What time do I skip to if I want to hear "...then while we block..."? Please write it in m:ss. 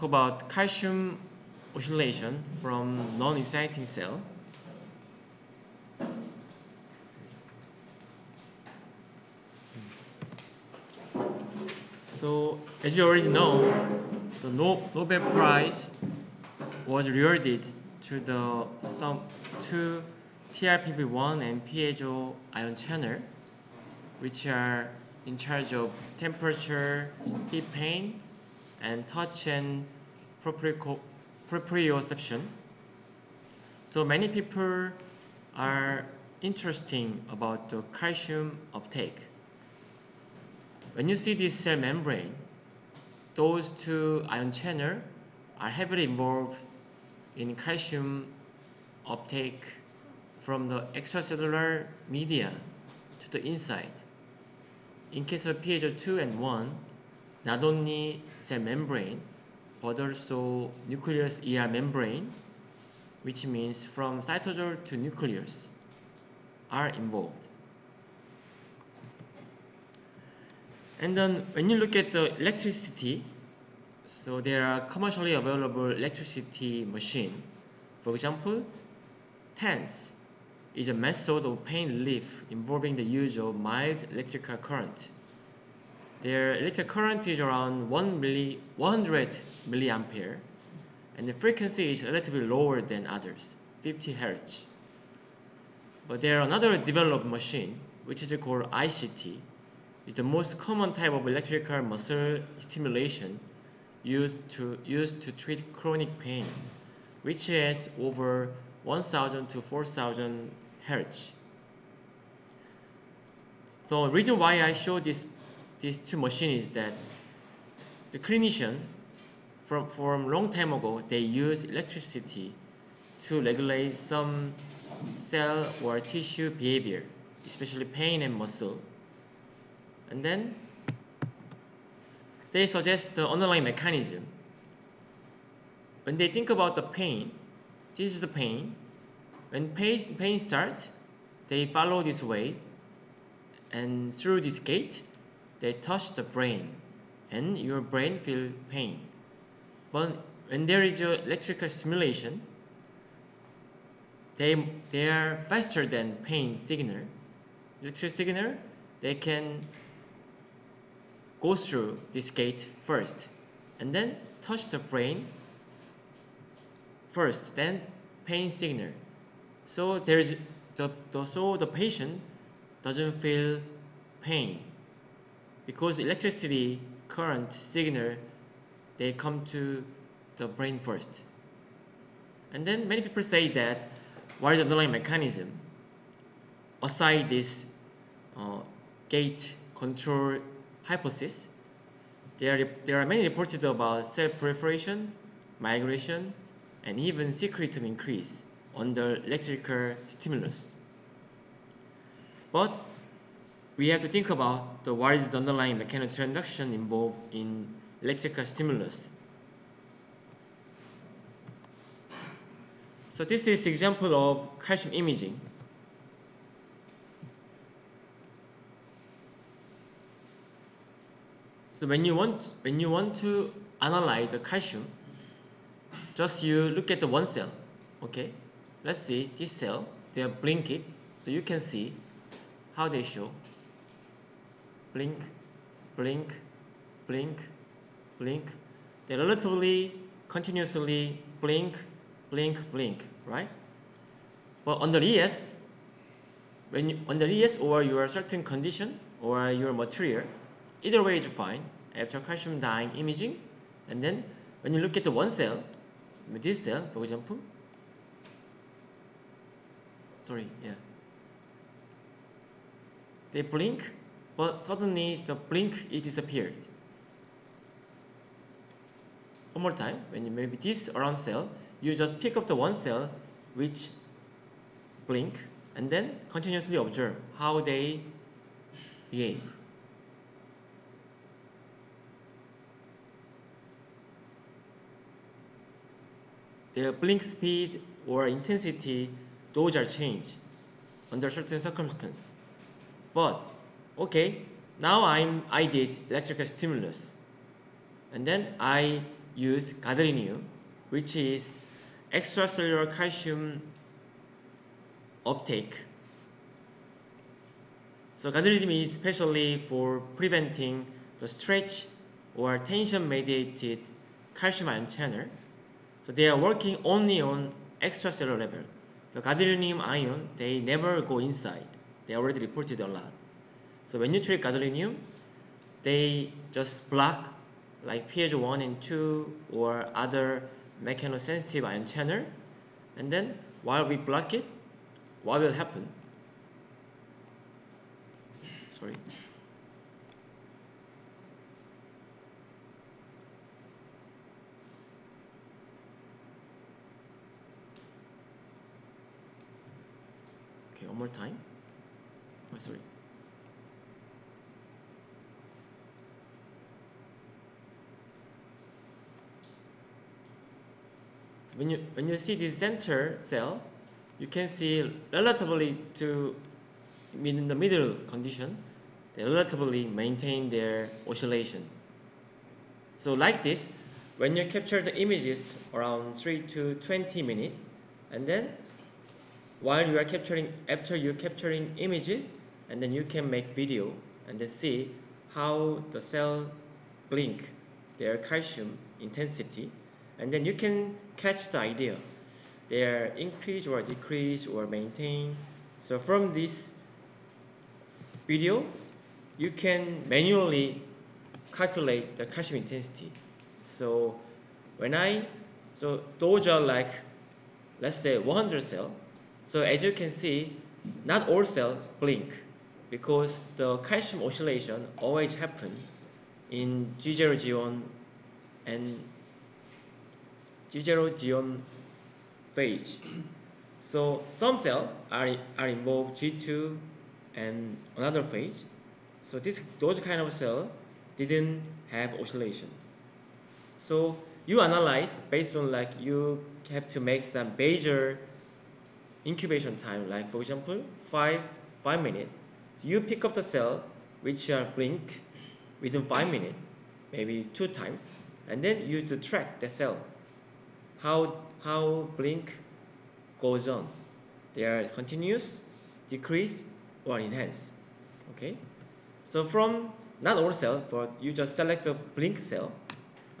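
5:33.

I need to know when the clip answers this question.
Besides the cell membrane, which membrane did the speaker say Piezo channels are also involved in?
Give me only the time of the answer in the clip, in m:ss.
1:00.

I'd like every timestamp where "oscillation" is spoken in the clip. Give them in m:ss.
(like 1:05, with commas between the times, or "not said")
0:01, 6:11, 6:54, 7:12.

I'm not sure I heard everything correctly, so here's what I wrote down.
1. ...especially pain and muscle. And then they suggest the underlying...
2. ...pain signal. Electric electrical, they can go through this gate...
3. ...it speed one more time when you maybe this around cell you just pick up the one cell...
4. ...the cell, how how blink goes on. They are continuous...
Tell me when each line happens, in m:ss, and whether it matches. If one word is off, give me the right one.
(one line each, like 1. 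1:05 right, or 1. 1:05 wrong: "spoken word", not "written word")
1. 2:07 right
2. 2:36 wrong: "signal", not "electrical"
3. 4:25 wrong: "disappeared", not "speed"
4. 7:29 right.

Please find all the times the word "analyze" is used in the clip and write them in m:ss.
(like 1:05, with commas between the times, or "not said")
3:43, 7:14.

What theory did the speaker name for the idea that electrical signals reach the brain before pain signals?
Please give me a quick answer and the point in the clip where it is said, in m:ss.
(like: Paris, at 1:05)
gate control hypothesis, at 3:09.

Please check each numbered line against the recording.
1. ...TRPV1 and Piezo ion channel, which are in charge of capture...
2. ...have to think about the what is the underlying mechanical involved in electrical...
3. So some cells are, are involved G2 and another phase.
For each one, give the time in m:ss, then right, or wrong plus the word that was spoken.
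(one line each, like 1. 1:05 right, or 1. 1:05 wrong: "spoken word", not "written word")
1. 0:20 wrong: "temperature", not "capture"
2. 3:23 right
3. 7:03 right.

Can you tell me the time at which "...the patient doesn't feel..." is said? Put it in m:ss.
2:51.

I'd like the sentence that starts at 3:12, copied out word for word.
There are, there are many reported about cell proliferation, migration, and even secretome increase under electrical stimulus.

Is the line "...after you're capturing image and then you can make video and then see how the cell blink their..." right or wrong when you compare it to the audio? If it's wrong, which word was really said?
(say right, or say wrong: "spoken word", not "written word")
right.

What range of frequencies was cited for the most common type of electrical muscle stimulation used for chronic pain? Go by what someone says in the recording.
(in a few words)
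1000 to 4000 Hz.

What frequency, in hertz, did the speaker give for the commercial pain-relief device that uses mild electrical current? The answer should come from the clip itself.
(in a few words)
50 Hz.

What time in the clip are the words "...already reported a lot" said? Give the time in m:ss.
5:22.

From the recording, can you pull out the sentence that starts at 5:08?
So gadolinium is especially for preventing the stretch or tension mediated calcium ion channel so they are working only on extracellular level.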